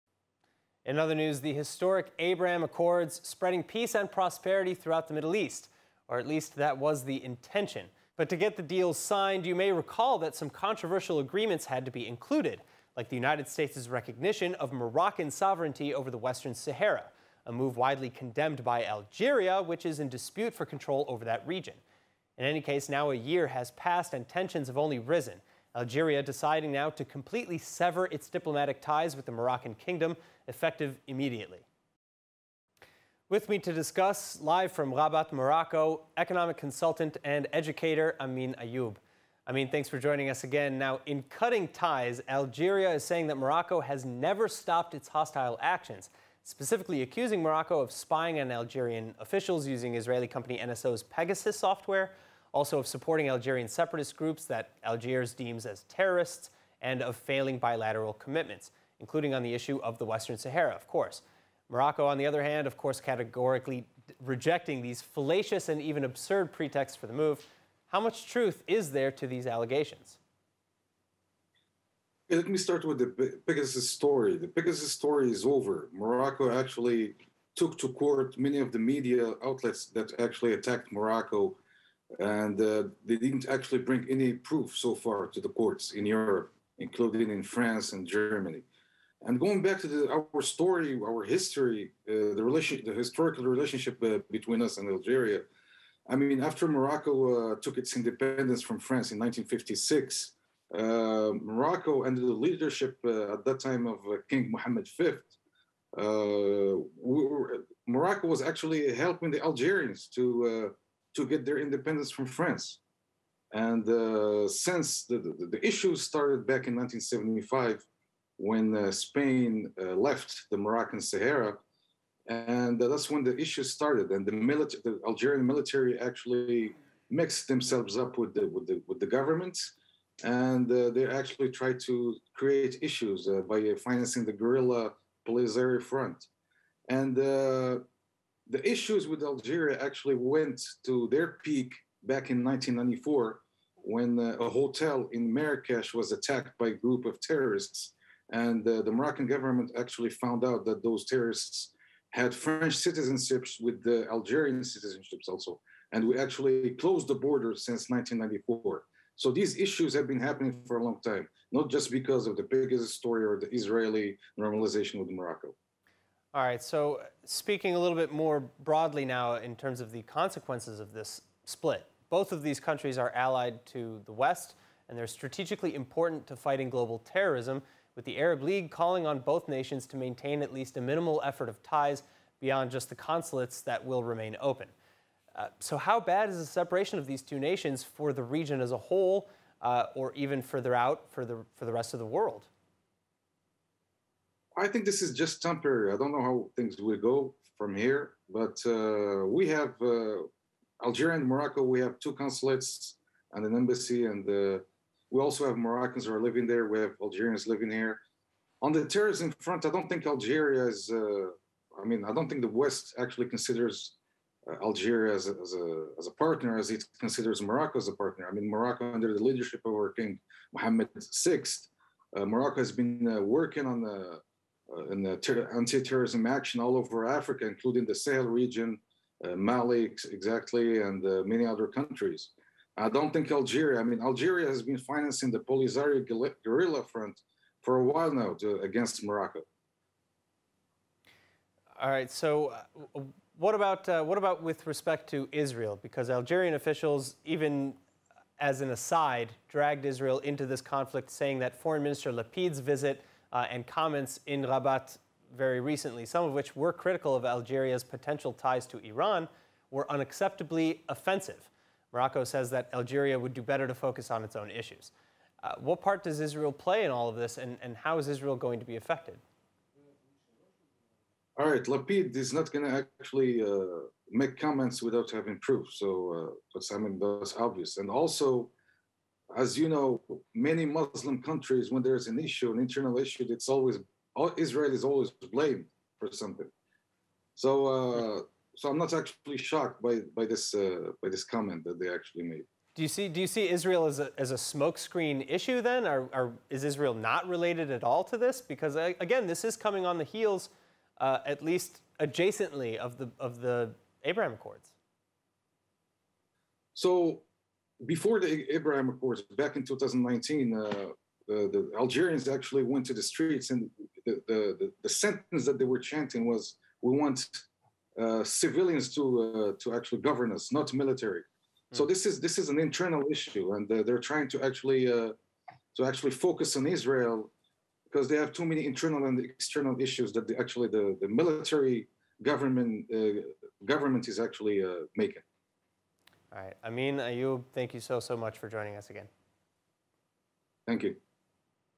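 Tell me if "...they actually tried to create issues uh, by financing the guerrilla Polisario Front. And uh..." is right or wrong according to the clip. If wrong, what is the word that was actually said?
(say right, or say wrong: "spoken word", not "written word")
right.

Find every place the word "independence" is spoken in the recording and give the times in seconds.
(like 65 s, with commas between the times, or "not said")
97 s, 111 s.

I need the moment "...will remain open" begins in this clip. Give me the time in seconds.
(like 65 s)
183 s.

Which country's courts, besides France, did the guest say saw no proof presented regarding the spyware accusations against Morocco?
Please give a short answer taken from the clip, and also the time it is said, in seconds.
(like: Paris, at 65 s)
Germany, at 88 s.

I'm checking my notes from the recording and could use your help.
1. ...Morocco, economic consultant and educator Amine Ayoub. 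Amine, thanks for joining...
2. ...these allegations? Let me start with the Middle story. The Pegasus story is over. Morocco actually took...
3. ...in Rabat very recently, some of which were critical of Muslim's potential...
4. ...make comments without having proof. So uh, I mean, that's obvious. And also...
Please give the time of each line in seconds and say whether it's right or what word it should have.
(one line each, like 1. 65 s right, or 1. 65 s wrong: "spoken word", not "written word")
1. 35 s right
2. 69 s wrong: "Pegasus", not "Middle"
3. 254 s wrong: "Algeria", not "Muslim"
4. 274 s right.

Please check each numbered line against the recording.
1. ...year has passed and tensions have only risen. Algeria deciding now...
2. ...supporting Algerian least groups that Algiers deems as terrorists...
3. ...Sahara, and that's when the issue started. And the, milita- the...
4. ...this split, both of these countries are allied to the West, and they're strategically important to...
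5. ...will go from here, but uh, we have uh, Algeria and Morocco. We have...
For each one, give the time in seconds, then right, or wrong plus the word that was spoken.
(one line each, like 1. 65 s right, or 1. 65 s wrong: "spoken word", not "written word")
1. 23 s right
2. 52 s wrong: "separatist", not "least"
3. 121 s right
4. 170 s right
5. 196 s right.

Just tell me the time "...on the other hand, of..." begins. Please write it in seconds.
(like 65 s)
62 s.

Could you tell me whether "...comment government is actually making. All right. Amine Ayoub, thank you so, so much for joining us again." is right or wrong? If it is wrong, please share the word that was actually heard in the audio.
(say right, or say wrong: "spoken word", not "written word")
wrong: "government", not "comment".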